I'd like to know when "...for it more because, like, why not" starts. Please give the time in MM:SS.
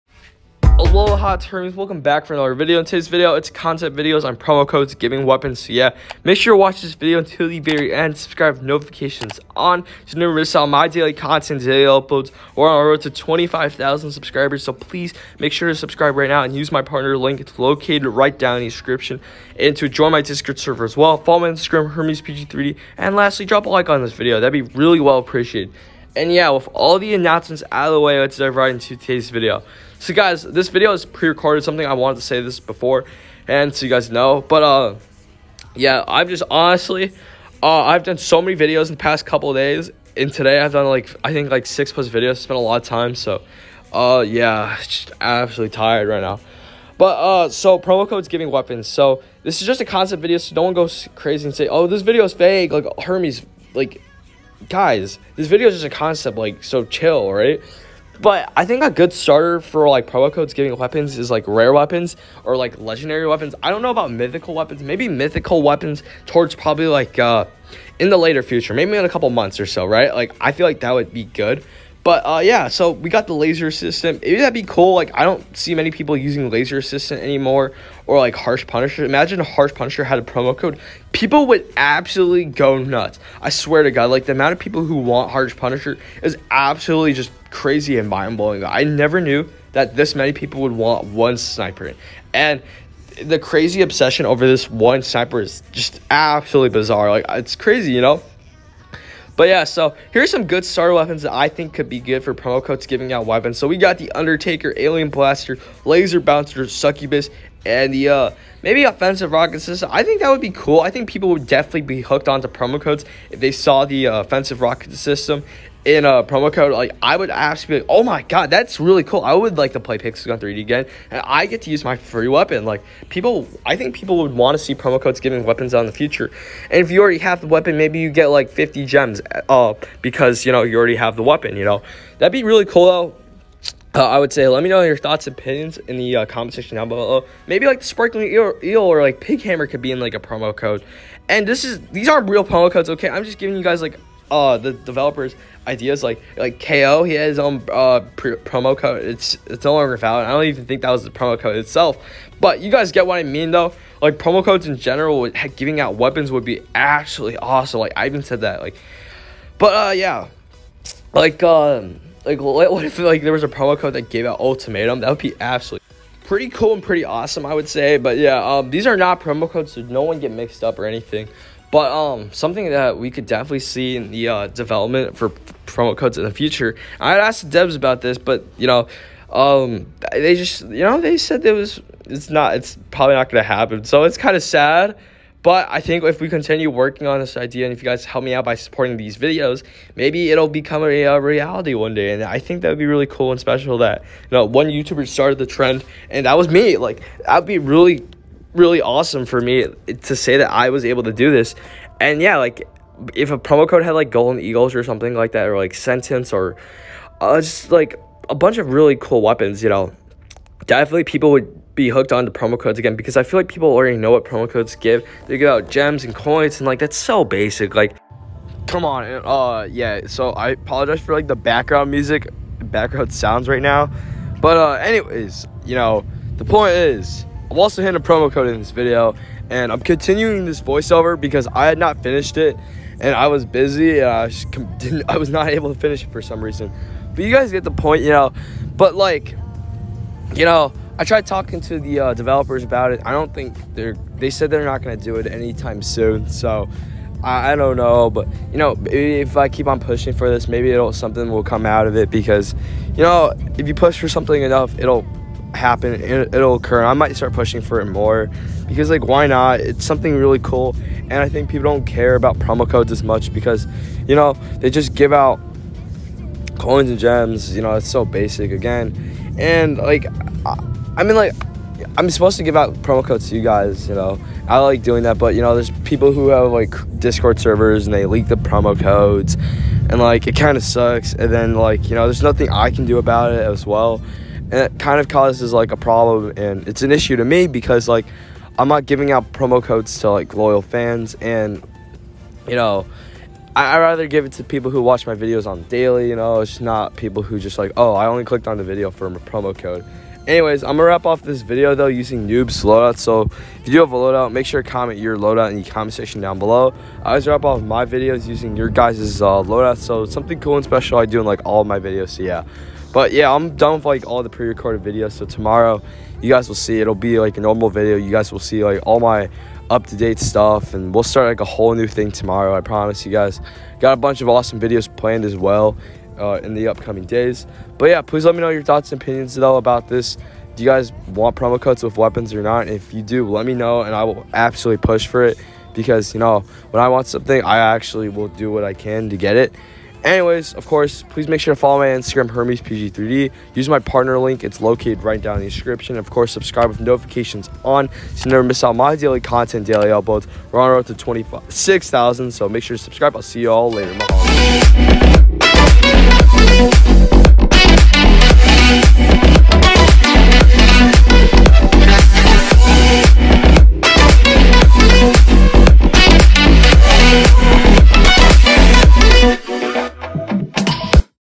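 04:17.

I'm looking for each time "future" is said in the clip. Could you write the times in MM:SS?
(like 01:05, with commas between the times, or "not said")
01:08, 02:05, 02:56.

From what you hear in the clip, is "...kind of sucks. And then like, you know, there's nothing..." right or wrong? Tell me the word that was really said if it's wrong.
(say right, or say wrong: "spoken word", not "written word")
right.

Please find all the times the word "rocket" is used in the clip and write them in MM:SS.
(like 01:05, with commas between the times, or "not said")
01:49, 01:54.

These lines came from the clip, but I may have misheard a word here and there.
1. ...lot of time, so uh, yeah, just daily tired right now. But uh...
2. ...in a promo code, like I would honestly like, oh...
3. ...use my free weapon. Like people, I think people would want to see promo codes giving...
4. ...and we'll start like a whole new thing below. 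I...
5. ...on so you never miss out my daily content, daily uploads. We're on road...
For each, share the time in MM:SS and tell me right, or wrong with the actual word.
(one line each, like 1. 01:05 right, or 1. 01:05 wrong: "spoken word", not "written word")
1. 00:42 wrong: "absolutely", not "daily"
2. 01:55 wrong: "absolutely", not "honestly"
3. 02:01 right
4. 05:20 wrong: "tomorrow", not "below"
5. 05:47 right.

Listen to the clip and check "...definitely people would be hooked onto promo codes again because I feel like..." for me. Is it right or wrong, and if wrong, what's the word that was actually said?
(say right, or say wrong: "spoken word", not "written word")
right.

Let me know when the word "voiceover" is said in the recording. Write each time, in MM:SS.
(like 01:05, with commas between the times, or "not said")
03:50.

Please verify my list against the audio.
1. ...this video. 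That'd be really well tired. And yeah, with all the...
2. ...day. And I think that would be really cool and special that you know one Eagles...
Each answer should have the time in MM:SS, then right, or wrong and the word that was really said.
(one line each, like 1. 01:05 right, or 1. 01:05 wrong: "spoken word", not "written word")
1. 00:24 wrong: "appreciated", not "tired"
2. 03:11 wrong: "YouTuber", not "Eagles".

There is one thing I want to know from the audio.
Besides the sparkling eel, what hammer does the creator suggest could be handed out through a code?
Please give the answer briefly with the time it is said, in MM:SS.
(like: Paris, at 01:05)
pig hammer, at 02:19.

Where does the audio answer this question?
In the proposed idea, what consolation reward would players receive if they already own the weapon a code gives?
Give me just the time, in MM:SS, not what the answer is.
02:08.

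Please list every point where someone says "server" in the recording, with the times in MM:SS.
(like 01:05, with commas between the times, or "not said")
00:20, 04:37.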